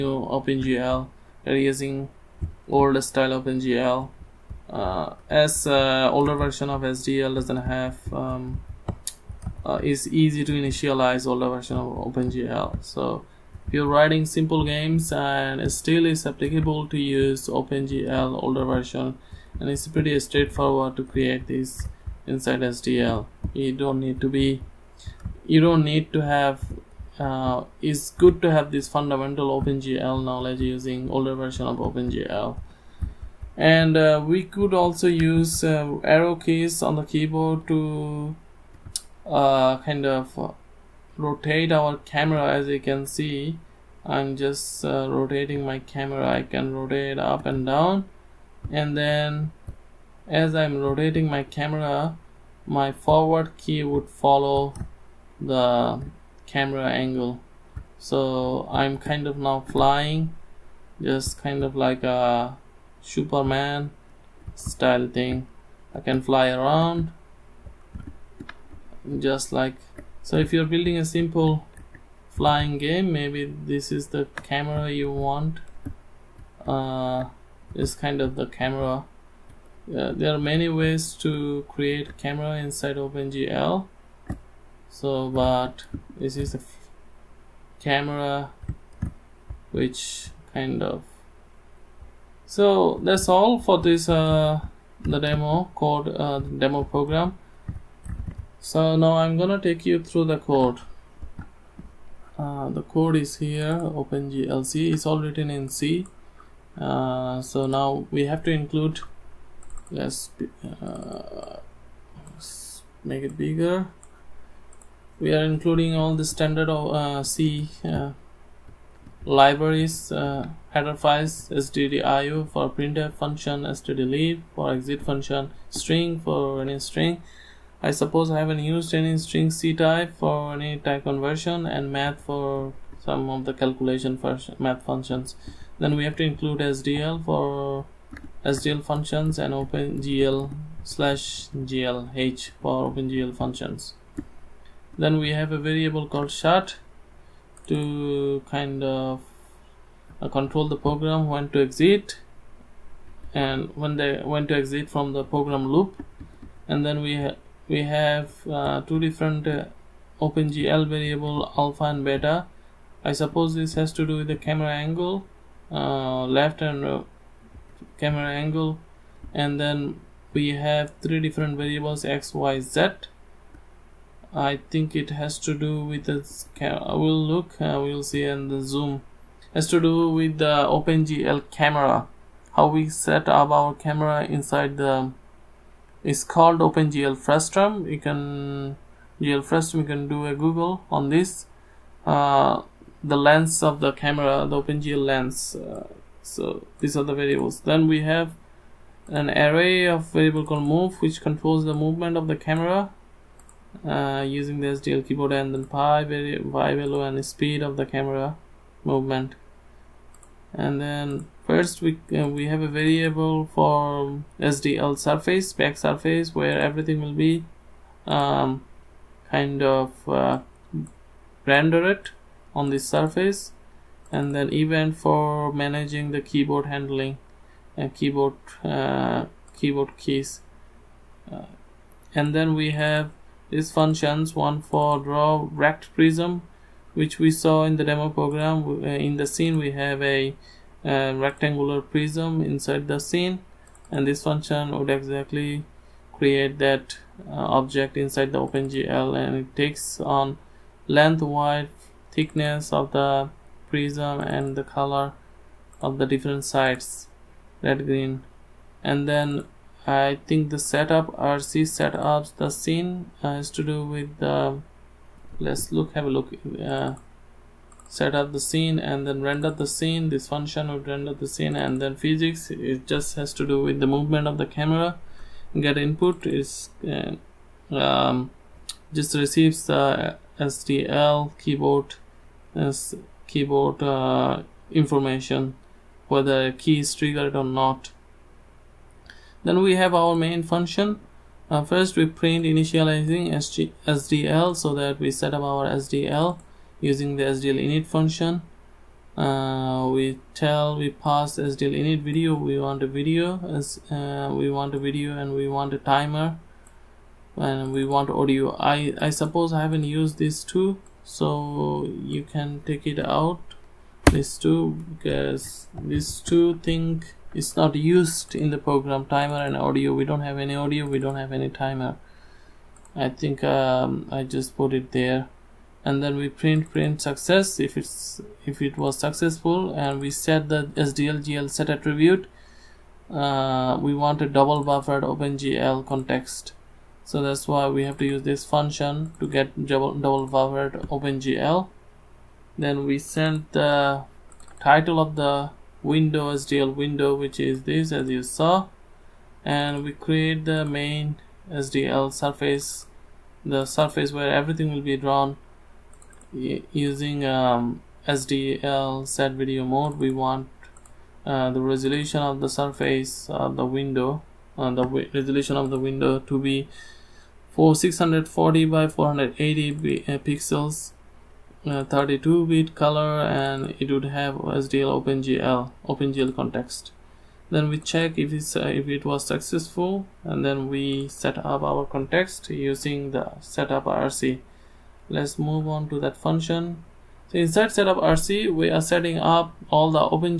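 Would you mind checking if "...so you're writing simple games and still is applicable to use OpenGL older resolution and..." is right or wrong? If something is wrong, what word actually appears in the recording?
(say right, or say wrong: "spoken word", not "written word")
wrong: "version", not "resolution".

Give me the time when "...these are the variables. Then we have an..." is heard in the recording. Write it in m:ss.
3:16.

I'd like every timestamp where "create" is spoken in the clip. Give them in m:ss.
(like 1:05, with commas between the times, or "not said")
0:21, 1:21, 4:06, 5:49.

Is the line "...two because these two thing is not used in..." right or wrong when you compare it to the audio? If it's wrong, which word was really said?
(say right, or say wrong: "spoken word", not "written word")
right.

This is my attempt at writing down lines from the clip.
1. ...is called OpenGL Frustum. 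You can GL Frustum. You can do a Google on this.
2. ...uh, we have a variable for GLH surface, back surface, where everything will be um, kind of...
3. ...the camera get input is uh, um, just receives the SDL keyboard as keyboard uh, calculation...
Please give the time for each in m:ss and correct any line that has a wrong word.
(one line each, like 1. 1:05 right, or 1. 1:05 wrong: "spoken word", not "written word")
1. 3:06 right
2. 3:32 wrong: "SDL", not "GLH"
3. 4:34 wrong: "information", not "calculation".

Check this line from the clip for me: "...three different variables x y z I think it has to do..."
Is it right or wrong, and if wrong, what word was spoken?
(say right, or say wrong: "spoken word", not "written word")
right.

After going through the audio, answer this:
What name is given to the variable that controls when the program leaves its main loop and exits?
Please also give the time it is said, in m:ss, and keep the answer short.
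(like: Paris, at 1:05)
shut, at 2:26.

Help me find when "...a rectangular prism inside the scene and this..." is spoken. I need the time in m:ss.
4:00.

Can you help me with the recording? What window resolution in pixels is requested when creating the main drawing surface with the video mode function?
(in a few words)
640 by 480.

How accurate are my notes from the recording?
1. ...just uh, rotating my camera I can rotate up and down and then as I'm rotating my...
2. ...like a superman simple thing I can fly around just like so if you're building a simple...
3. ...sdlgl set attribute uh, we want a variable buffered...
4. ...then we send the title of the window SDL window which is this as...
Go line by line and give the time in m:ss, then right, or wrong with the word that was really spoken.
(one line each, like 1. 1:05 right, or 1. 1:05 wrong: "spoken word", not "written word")
1. 0:44 right
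2. 1:01 wrong: "style", not "simple"
3. 5:30 wrong: "double", not "variable"
4. 5:42 right.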